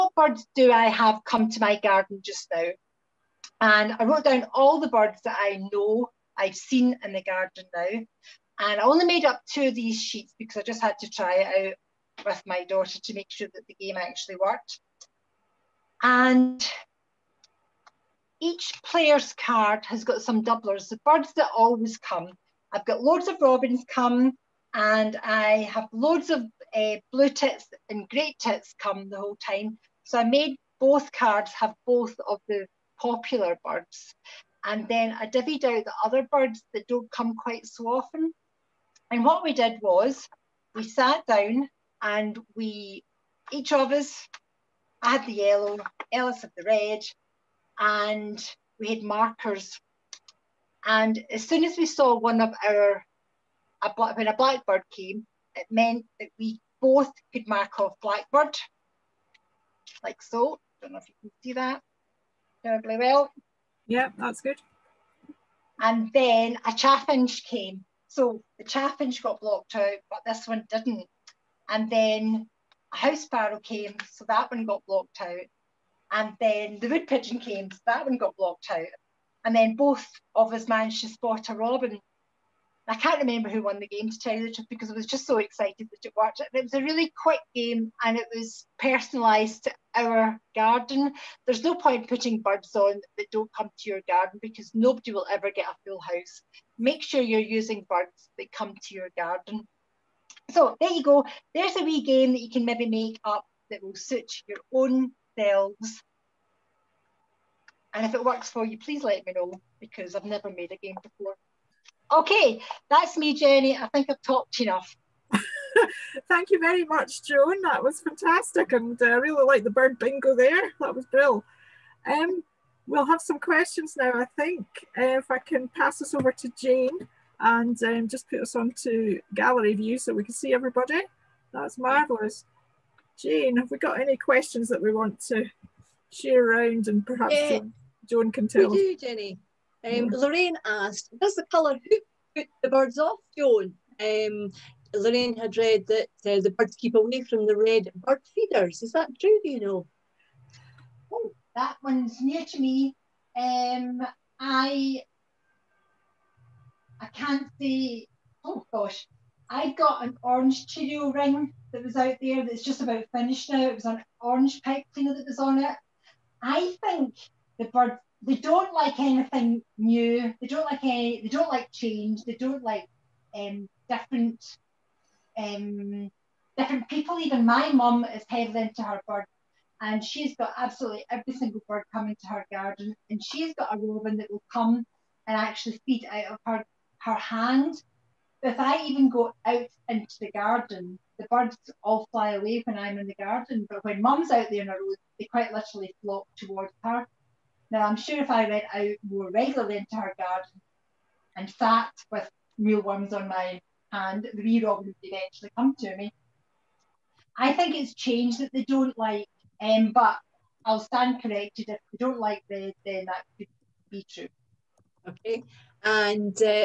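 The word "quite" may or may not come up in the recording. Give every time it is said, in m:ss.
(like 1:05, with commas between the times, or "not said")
0:37, 3:15.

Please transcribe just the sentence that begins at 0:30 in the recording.
So I made both cards have both of the popular birds.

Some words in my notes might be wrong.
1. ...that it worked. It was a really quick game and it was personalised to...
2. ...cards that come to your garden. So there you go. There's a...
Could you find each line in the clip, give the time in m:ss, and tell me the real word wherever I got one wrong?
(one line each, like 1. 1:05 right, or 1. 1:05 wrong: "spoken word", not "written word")
1. 1:25 right
2. 1:37 wrong: "birds", not "cards".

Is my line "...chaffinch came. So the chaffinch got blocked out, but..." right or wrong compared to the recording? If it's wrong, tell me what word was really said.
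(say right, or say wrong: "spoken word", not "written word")
right.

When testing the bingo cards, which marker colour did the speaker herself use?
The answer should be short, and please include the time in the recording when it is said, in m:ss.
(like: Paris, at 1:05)
Yellow, at 0:45.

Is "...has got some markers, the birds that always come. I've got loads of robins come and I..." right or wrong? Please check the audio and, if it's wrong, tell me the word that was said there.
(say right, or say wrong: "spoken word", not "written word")
wrong: "doublers", not "markers".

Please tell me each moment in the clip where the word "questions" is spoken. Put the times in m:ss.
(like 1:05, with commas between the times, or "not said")
2:03, 2:14.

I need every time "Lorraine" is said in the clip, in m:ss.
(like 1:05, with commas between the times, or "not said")
2:20, 2:24.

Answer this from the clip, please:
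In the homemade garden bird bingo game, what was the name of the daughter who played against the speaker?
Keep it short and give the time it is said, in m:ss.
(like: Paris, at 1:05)
Ellis, at 0:46.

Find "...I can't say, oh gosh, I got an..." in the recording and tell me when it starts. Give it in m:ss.
2:36.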